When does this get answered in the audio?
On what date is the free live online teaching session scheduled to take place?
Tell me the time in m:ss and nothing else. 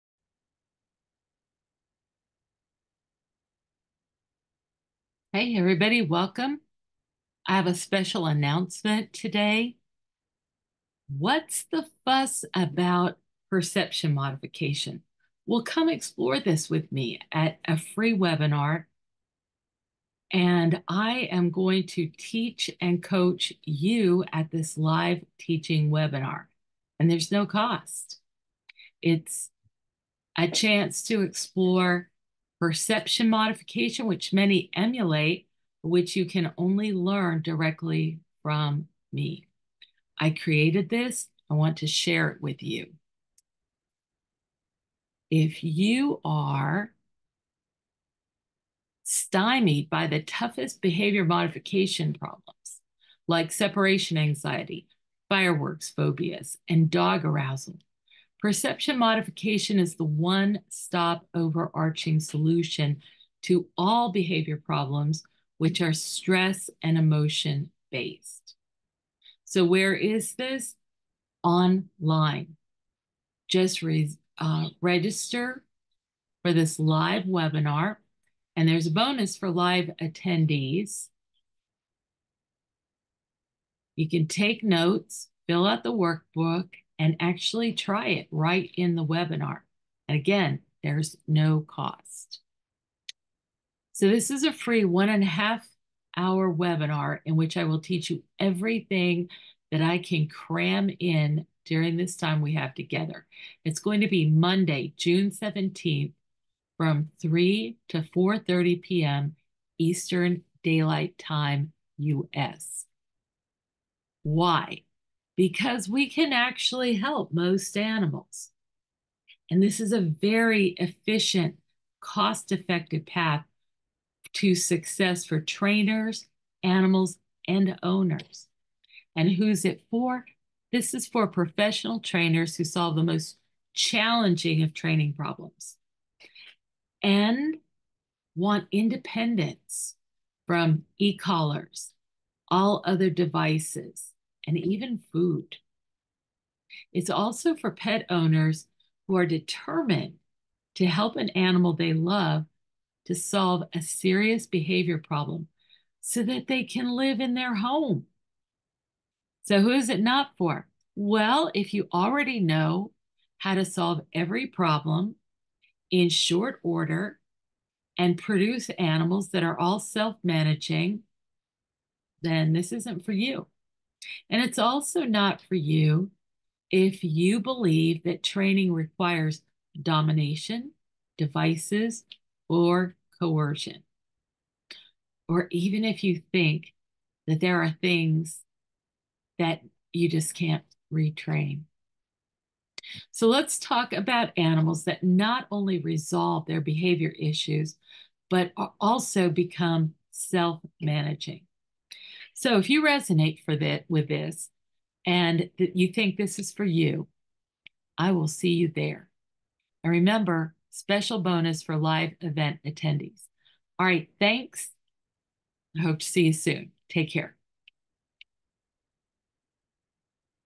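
1:44.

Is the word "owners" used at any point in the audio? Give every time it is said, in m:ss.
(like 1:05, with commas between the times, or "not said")
2:07, 2:28.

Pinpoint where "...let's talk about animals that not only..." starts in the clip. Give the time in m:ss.
3:13.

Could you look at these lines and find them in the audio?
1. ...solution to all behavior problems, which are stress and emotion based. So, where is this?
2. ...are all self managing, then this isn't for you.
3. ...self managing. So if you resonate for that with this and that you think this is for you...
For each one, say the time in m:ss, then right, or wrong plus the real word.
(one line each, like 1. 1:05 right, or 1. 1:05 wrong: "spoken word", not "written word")
1. 1:02 right
2. 2:49 right
3. 3:20 right.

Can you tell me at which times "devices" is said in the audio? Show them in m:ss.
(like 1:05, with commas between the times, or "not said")
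2:23, 3:01.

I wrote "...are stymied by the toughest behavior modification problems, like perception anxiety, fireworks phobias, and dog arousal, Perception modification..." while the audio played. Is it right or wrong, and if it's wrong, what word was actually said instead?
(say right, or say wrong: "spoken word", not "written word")
wrong: "separation", not "perception".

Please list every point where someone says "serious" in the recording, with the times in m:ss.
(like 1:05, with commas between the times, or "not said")
2:33.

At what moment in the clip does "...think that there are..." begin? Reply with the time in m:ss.
3:06.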